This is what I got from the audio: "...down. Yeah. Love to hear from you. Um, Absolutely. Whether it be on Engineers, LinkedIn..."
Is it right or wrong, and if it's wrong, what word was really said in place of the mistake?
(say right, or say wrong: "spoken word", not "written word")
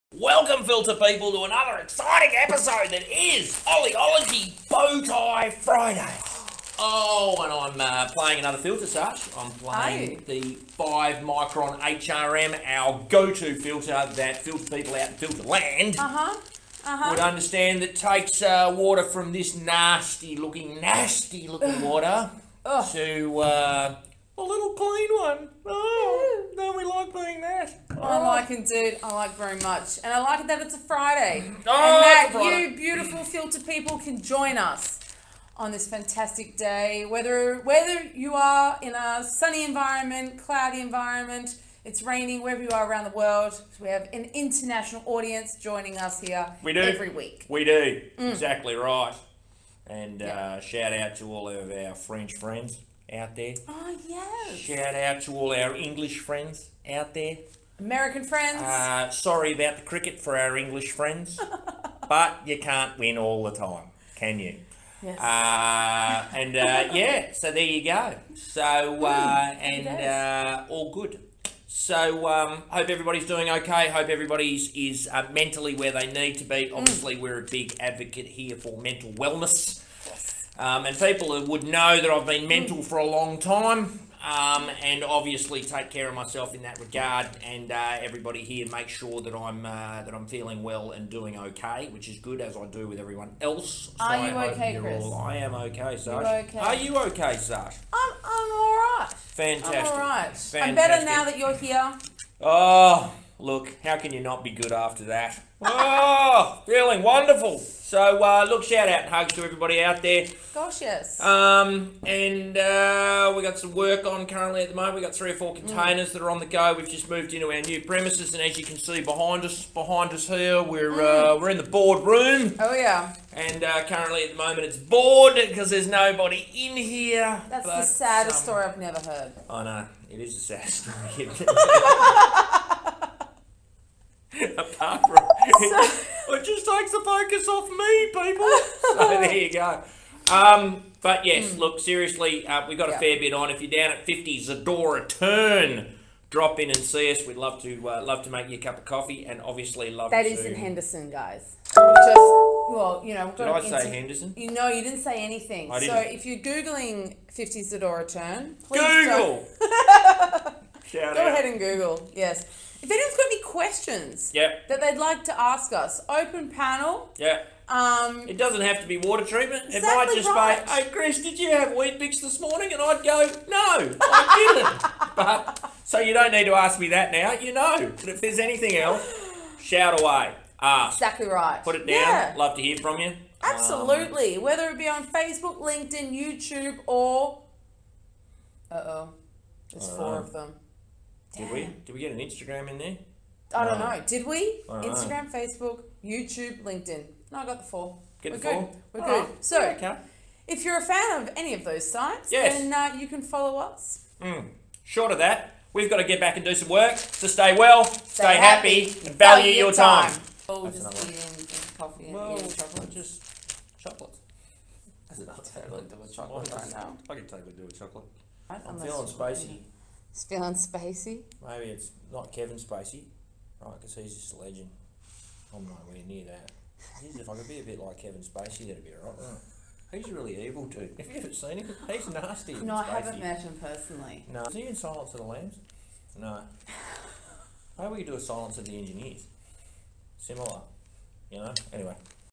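wrong: "Facebook", not "Engineers".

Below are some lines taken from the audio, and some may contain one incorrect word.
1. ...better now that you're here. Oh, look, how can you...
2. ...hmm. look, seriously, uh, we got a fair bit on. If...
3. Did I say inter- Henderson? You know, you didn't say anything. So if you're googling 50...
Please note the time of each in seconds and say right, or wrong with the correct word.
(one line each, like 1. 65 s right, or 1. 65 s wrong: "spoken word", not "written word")
1. 100 s right
2. 141 s right
3. 153 s right.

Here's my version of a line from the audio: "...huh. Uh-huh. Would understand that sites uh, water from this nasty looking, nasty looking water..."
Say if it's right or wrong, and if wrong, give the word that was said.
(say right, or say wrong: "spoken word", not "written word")
wrong: "takes", not "sites".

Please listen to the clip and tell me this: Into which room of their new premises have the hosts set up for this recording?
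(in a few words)
The board room.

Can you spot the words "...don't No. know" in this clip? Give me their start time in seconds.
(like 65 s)
193 s.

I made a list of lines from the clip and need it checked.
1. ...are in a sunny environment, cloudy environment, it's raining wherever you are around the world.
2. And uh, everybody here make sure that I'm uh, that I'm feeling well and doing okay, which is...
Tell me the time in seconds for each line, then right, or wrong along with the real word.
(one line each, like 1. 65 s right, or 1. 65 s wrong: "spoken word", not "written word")
1. 38 s right
2. 87 s right.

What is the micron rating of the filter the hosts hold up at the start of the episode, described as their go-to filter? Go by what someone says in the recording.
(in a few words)
5.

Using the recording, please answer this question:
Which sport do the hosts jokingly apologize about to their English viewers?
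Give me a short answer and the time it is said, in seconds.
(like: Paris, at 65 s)
Cricket, at 59 s.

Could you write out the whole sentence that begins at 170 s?
be, hey, Chris, did you have Weet-Bix this morning?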